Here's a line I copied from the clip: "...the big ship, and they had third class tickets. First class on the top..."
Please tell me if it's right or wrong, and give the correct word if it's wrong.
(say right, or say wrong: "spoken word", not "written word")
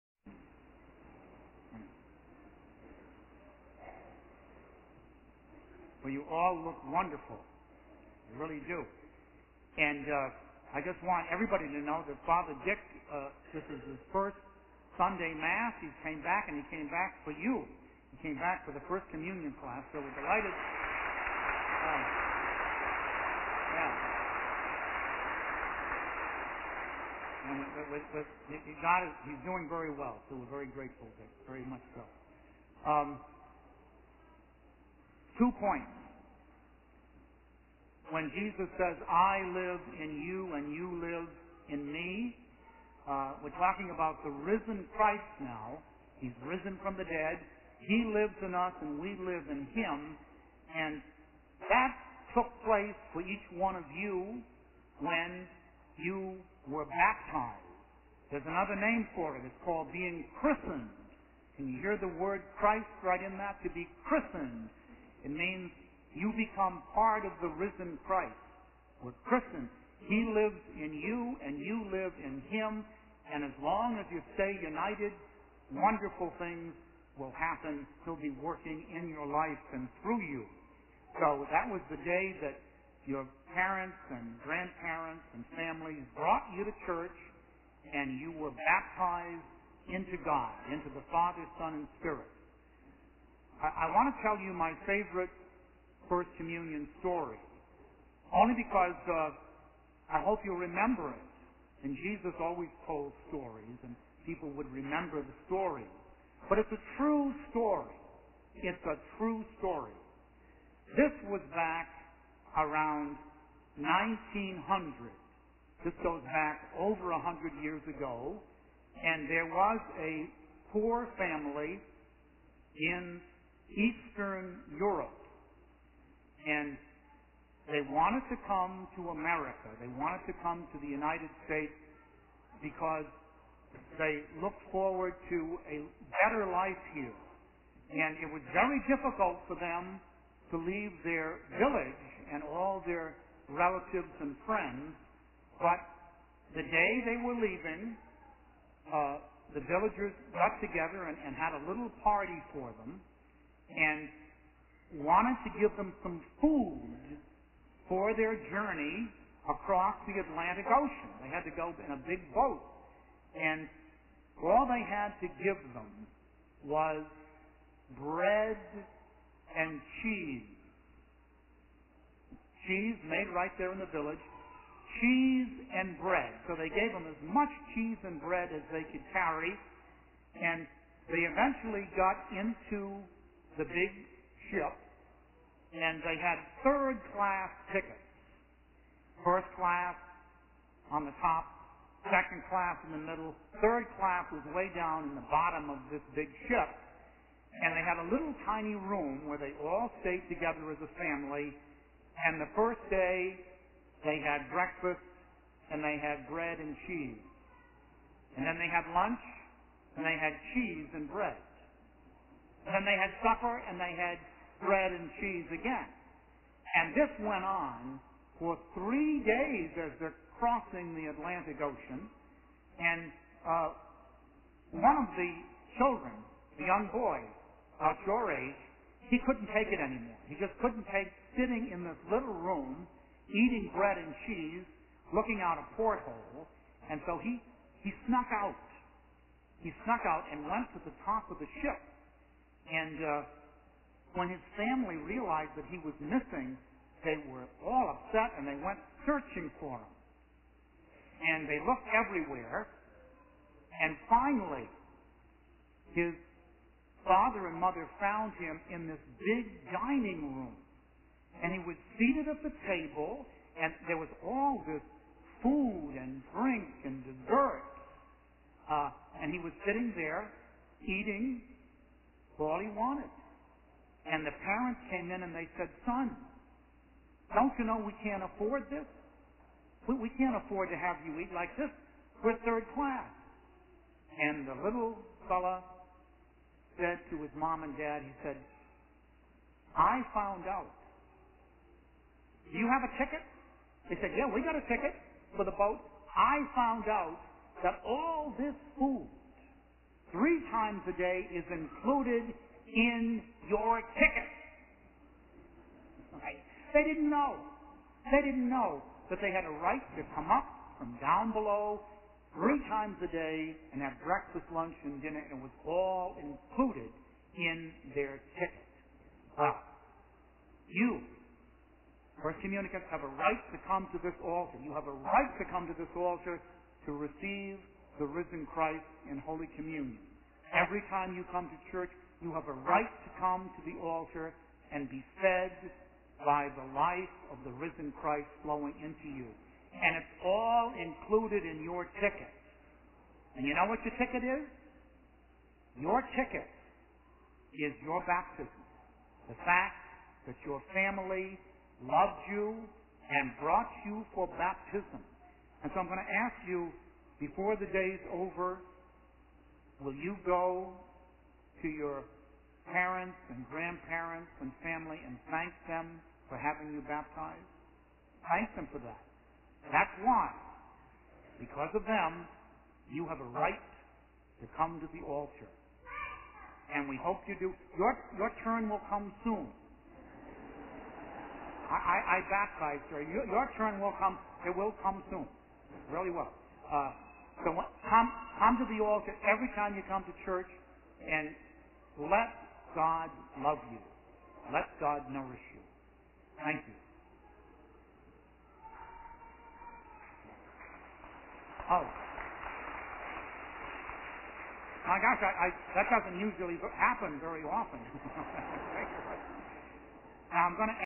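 right.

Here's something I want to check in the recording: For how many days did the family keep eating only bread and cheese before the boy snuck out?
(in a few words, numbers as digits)
3.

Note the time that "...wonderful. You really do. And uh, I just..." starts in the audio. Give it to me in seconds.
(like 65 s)
6 s.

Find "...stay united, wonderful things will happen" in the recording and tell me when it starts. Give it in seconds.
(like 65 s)
74 s.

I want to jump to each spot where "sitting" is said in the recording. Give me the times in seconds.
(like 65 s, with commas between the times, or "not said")
231 s, 269 s.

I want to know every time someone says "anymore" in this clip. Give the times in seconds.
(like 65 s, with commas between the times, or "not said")
229 s.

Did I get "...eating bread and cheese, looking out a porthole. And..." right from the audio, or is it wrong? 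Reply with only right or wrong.
right.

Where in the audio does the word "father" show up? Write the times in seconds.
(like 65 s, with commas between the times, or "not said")
12 s, 91 s, 257 s.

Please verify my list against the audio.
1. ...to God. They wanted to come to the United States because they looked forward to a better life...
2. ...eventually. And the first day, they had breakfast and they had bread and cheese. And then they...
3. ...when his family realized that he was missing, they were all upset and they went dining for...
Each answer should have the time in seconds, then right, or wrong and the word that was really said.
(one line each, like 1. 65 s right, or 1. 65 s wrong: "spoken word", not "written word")
1. 128 s wrong: "America", not "God"
2. 200 s wrong: "family", not "eventually"
3. 244 s wrong: "searching", not "dining".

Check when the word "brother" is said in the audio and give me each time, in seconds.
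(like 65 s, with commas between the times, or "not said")
not said.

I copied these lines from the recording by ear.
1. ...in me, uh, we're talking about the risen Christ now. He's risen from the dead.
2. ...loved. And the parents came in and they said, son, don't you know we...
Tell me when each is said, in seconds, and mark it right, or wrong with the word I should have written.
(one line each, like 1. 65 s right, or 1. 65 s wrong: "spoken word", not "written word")
1. 41 s right
2. 272 s wrong: "wanted", not "loved".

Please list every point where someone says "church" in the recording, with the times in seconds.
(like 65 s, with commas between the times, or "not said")
86 s, 331 s, 390 s.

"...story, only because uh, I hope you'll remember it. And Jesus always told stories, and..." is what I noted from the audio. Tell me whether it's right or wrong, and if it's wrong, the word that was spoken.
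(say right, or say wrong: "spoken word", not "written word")
right.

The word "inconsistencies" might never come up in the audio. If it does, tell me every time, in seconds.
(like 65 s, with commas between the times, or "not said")
not said.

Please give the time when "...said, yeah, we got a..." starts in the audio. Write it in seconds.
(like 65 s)
294 s.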